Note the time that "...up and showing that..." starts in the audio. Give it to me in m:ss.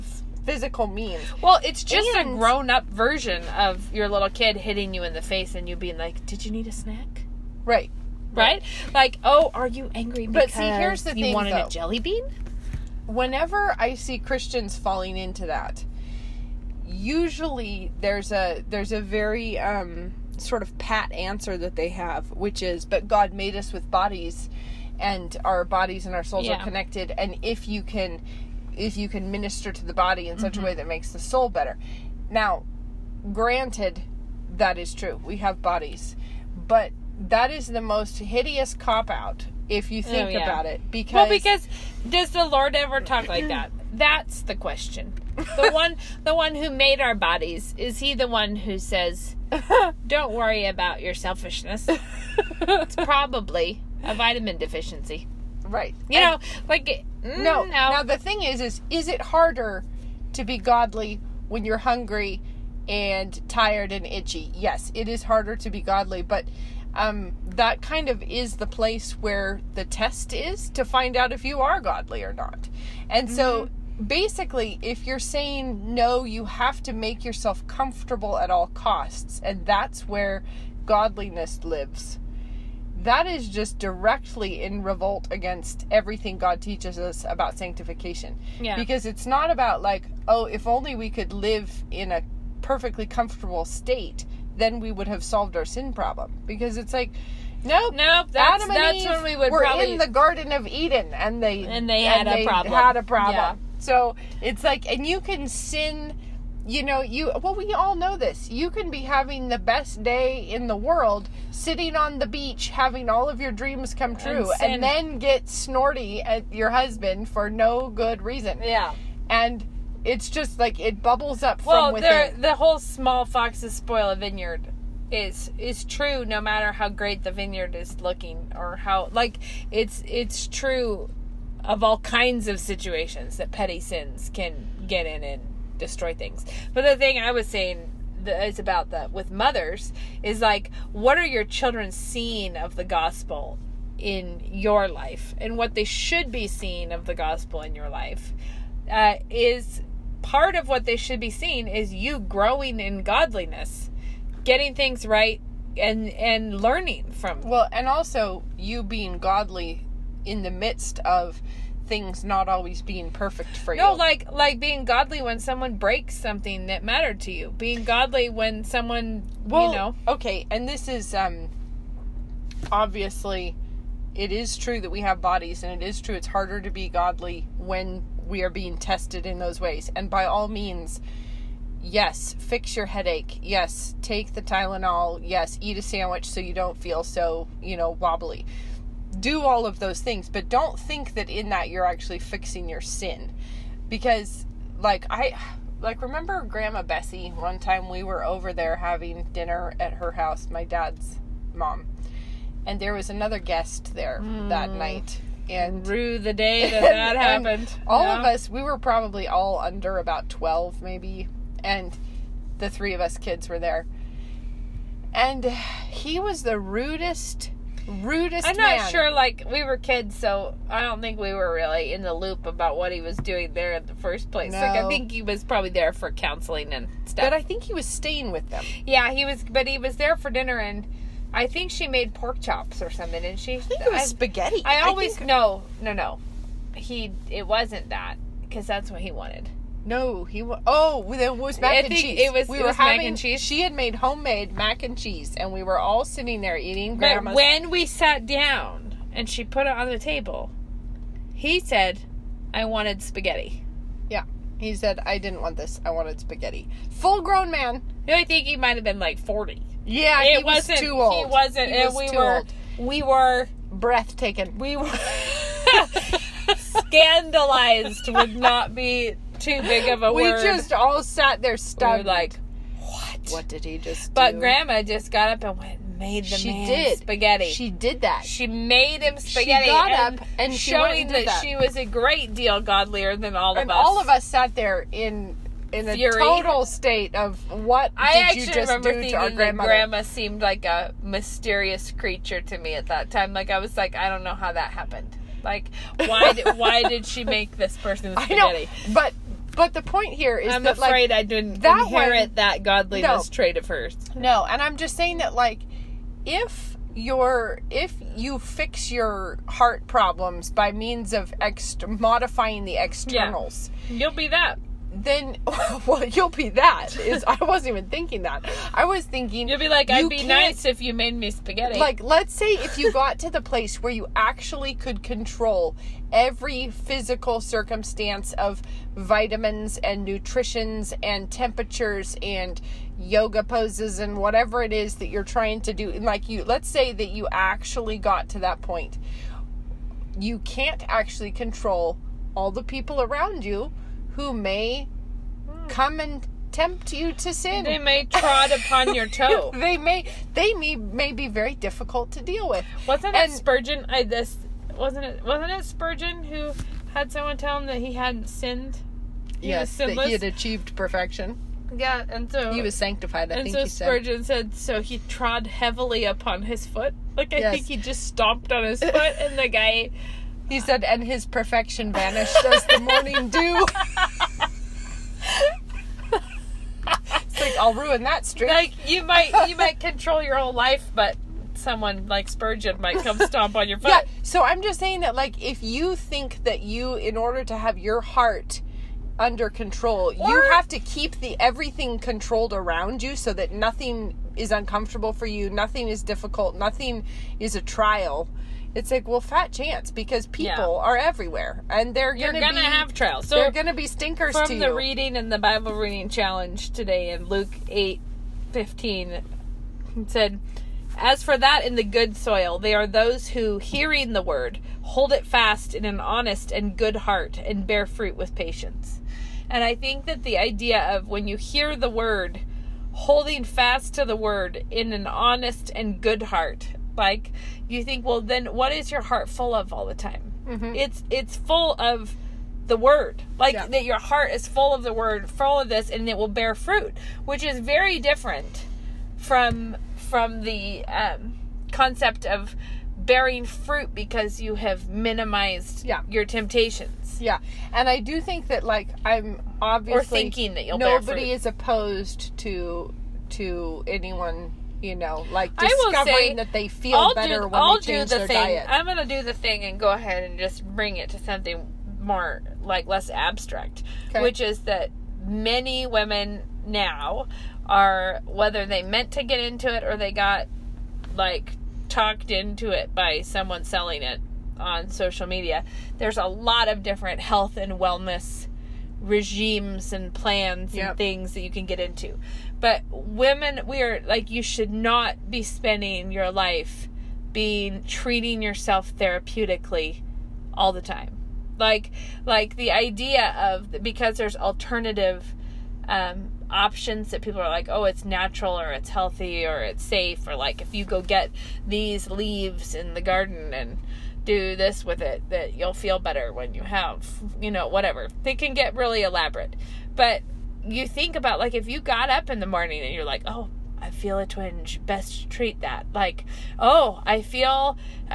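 4:40.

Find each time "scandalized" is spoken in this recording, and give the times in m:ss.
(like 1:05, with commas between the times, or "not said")
4:26.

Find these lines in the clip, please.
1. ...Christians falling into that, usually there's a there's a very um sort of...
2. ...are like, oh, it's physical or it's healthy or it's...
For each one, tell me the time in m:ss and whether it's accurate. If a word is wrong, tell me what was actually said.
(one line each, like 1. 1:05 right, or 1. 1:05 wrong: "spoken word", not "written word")
1. 0:14 right
2. 8:17 wrong: "natural", not "physical".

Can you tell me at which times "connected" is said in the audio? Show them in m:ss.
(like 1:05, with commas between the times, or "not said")
0:26.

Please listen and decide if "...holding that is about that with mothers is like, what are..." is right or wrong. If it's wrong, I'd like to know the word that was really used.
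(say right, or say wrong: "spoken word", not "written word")
wrong: "saying", not "holding".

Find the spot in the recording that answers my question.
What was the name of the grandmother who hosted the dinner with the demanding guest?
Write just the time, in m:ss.
3:16.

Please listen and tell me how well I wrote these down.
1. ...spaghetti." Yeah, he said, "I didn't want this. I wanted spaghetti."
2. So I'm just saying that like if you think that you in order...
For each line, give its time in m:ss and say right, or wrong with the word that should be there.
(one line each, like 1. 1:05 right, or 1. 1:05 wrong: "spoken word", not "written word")
1. 4:13 right
2. 6:24 right.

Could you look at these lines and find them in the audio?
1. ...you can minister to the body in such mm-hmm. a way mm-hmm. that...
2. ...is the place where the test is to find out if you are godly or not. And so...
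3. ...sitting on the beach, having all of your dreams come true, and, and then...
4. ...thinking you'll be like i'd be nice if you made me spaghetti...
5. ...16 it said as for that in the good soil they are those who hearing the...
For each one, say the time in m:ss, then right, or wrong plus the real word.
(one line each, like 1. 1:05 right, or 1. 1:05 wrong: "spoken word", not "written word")
1. 0:28 right
2. 1:08 right
3. 1:51 right
4. 5:19 right
5. 6:48 wrong: "15", not "16".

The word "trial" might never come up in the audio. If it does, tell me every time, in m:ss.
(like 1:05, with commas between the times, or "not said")
6:37, 6:42.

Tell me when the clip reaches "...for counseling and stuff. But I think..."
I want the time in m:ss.
3:45.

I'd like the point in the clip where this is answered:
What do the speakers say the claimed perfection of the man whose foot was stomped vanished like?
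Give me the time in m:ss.
6:12.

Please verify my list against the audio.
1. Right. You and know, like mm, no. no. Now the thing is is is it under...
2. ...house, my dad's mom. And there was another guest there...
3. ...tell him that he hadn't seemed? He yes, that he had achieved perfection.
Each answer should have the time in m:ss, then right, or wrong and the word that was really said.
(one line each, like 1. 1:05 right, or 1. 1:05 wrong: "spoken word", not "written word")
1. 0:55 wrong: "harder", not "under"
2. 3:20 right
3. 5:57 wrong: "sinned", not "seemed".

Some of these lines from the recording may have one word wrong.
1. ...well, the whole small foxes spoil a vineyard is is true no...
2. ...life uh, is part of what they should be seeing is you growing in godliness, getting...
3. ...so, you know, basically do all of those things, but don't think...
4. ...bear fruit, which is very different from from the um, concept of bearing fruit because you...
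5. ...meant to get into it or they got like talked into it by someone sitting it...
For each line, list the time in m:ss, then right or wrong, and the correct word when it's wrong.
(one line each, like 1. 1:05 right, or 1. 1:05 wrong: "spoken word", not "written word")
1. 2:01 right
2. 2:27 right
3. 3:07 wrong: "wobbly", not "basically"
4. 7:16 right
5. 7:48 wrong: "selling", not "sitting".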